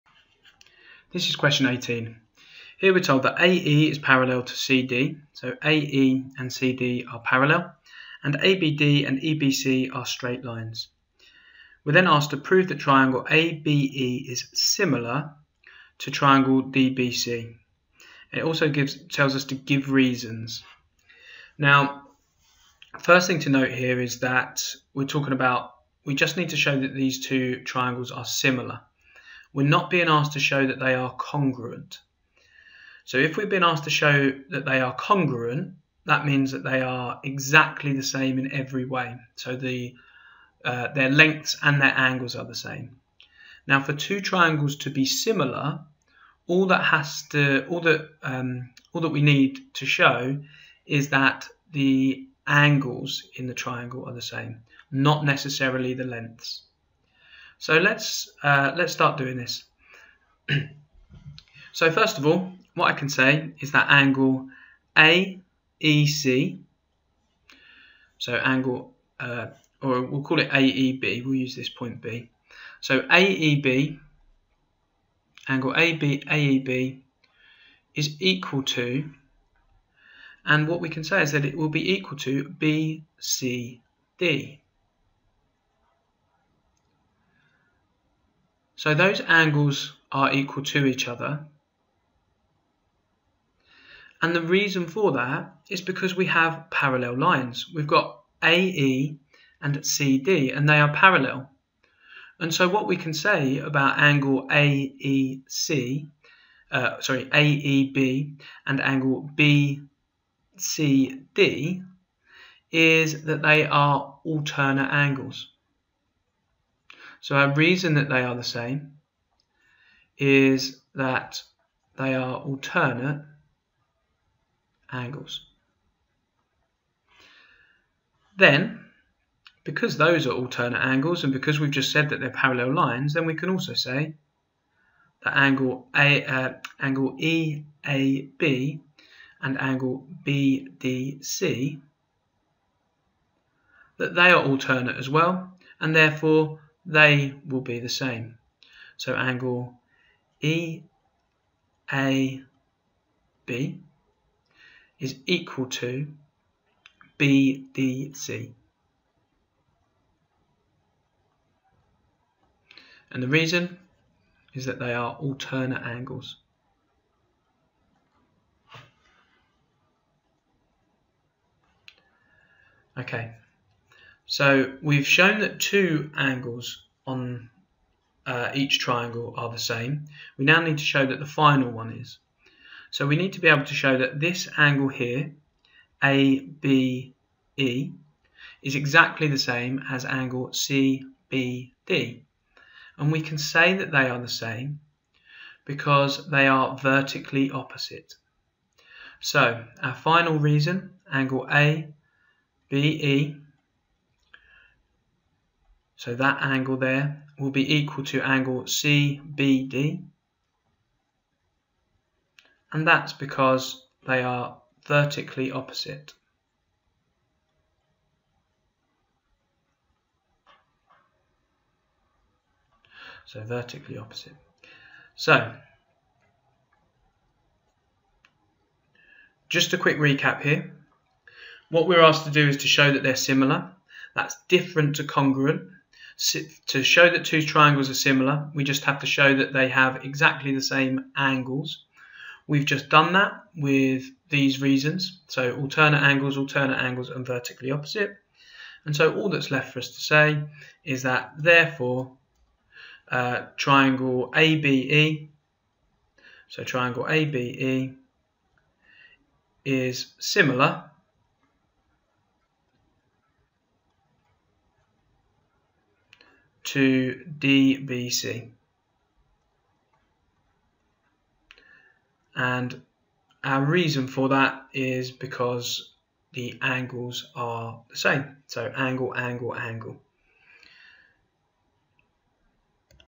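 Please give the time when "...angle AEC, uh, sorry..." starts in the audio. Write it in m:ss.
1:43.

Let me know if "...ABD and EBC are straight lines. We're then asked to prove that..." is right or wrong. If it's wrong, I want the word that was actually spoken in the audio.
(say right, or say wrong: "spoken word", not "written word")
right.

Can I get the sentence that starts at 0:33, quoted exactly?
So if we've been asked to show that they are congruent, that means that they are exactly the same in every way.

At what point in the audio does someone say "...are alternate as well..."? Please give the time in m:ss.
2:24.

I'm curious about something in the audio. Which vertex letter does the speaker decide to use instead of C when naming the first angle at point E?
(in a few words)
B.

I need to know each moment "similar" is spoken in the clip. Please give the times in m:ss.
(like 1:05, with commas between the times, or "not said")
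0:14, 0:28, 0:45, 3:53, 3:57, 4:20.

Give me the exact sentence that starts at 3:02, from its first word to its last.
So we need to be able to show that this angle here, ABE, is exactly the same as angle CBD.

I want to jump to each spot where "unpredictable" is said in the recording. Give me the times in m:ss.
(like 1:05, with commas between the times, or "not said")
not said.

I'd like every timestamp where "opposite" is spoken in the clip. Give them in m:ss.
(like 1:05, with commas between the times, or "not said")
3:17, 3:35, 3:43, 4:07.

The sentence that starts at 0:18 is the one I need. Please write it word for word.
It also gives tells us to give reasons.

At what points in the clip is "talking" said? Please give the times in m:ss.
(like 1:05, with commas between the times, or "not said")
0:25.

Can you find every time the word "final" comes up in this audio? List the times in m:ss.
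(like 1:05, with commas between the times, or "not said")
3:01, 3:19.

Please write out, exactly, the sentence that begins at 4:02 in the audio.
We've just done that with these reasons.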